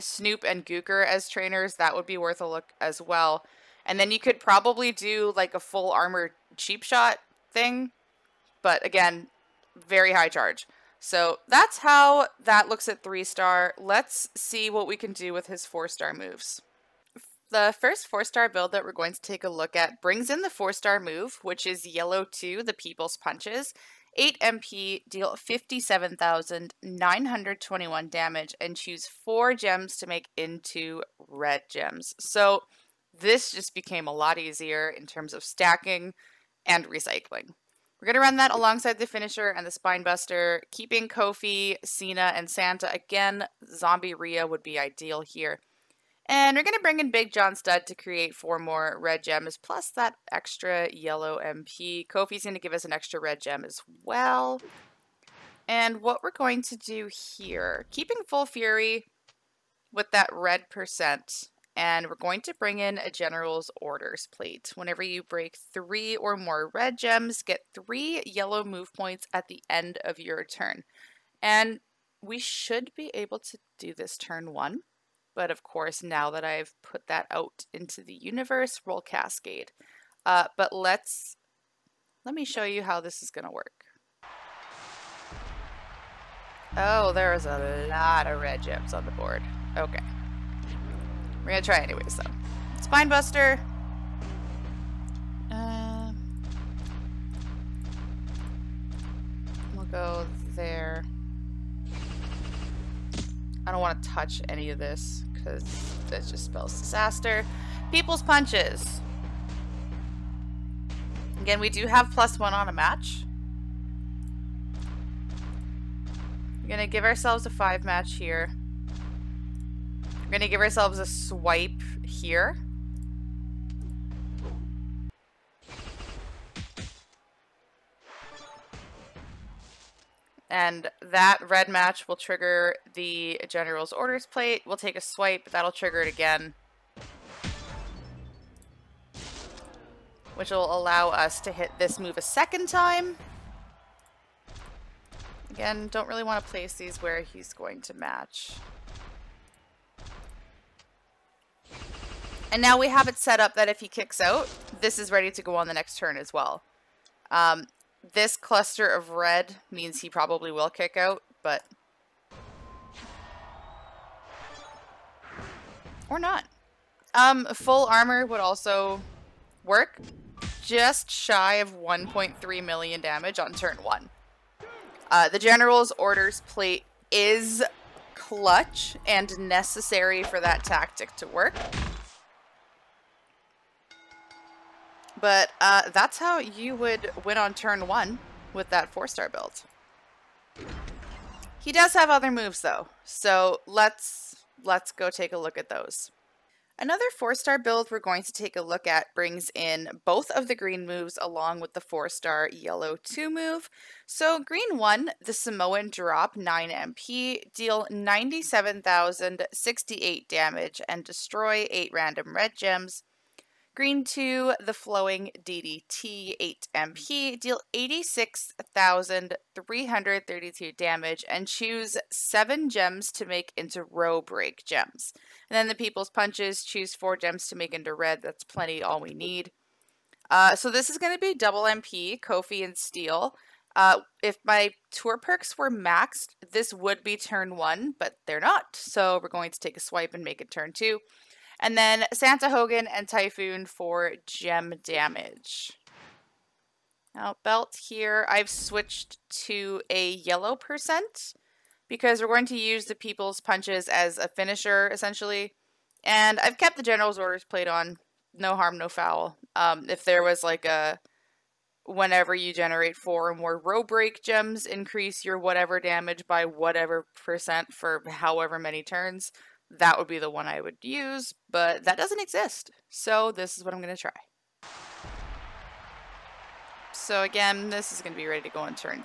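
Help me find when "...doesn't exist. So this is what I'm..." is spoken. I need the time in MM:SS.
04:31.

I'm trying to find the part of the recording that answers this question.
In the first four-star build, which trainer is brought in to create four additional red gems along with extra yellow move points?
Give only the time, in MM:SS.
00:47.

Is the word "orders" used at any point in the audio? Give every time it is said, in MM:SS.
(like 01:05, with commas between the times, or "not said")
01:03, 02:13, 02:55, 04:17.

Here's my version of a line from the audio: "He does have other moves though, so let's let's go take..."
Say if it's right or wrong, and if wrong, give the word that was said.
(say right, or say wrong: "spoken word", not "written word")
right.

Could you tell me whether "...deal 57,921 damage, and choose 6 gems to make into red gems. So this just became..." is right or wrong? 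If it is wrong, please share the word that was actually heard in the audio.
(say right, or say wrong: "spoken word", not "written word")
wrong: "4", not "6".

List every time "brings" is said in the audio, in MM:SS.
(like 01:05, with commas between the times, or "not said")
00:20, 00:46, 01:02, 03:19.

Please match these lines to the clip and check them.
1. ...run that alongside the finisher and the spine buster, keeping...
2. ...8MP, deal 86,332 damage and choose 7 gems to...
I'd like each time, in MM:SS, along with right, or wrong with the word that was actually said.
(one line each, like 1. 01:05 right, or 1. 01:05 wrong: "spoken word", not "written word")
1. 00:38 right
2. 03:36 right.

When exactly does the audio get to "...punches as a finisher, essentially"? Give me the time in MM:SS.
04:13.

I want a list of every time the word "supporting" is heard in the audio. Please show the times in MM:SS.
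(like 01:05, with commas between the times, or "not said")
not said.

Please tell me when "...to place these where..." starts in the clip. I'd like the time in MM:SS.
02:26.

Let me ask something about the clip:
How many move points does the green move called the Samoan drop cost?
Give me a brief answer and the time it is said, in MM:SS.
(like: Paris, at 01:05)
9, at 03:26.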